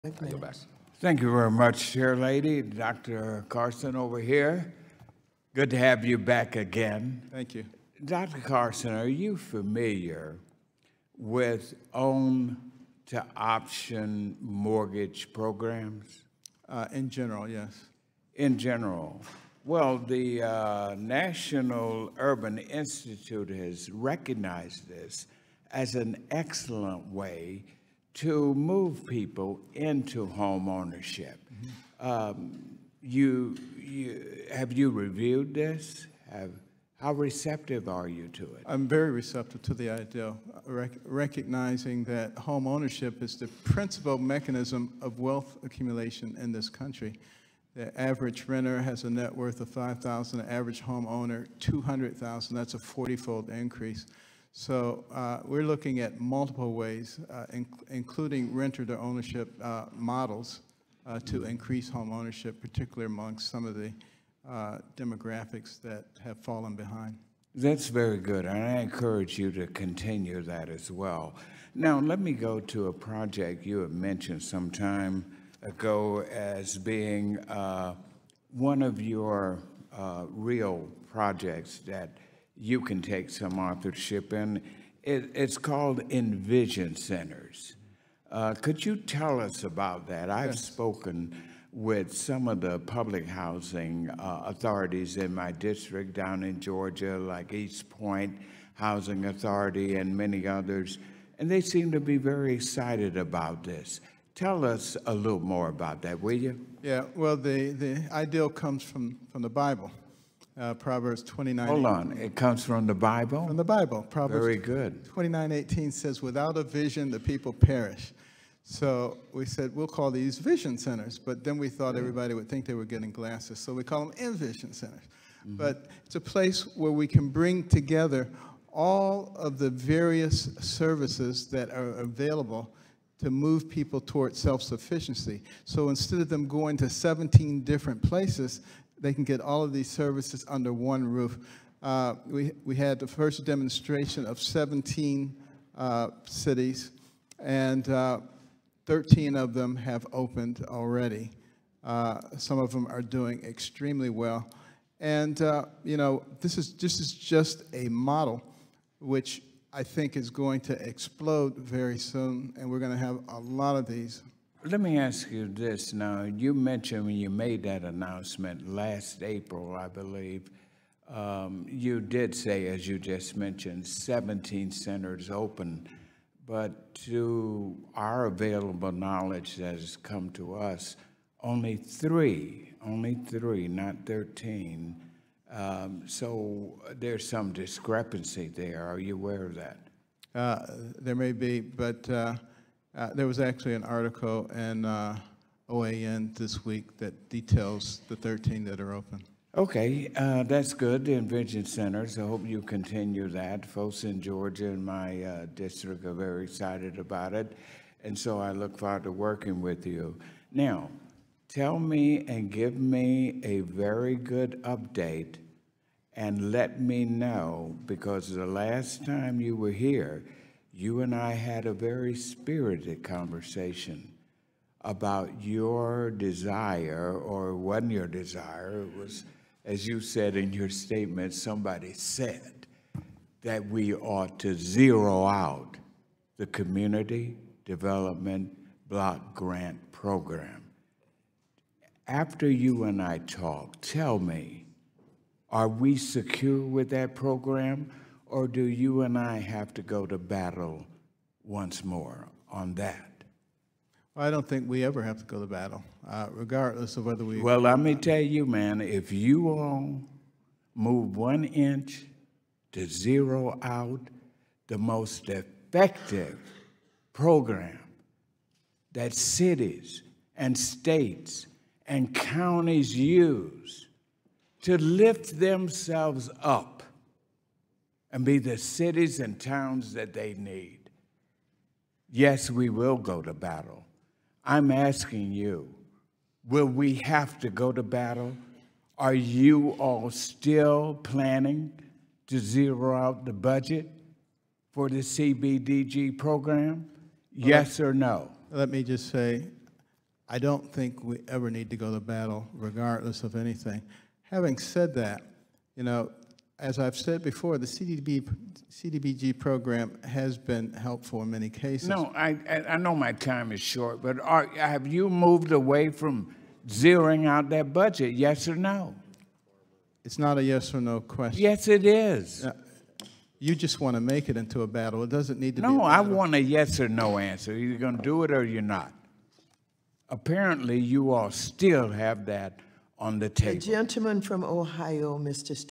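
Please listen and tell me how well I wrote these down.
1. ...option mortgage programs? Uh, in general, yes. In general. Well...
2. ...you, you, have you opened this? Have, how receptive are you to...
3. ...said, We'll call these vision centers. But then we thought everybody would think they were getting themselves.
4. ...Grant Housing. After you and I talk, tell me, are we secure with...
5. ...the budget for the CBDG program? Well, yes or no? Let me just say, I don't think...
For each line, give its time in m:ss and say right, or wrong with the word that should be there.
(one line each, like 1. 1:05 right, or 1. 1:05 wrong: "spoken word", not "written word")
1. 0:13 right
2. 0:33 wrong: "reviewed", not "opened"
3. 1:59 wrong: "glasses", not "themselves"
4. 3:59 wrong: "Program", not "Housing"
5. 4:53 right.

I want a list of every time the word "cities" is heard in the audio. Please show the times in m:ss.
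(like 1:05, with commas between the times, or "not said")
2:26, 4:29, 4:38.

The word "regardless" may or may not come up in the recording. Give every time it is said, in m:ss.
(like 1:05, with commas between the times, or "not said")
4:16, 5:02.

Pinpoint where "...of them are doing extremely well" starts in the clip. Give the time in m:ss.
2:32.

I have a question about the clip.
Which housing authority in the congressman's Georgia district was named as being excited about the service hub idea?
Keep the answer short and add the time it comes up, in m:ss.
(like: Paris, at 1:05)
East Point Housing Authority, at 1:37.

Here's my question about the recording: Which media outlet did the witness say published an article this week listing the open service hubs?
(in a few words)
OAN.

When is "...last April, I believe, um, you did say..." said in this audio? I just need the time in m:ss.
2:48.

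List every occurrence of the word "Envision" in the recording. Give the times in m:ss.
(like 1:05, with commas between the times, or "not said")
1:26, 3:21.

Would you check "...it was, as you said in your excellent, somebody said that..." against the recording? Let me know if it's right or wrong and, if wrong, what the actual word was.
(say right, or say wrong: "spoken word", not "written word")
wrong: "statement", not "excellent".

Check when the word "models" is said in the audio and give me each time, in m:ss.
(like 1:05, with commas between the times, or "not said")
0:59, 2:37.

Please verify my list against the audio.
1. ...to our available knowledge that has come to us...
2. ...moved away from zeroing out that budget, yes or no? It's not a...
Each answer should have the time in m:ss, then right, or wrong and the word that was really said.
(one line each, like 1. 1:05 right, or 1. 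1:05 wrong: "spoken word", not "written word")
1. 2:57 right
2. 5:15 right.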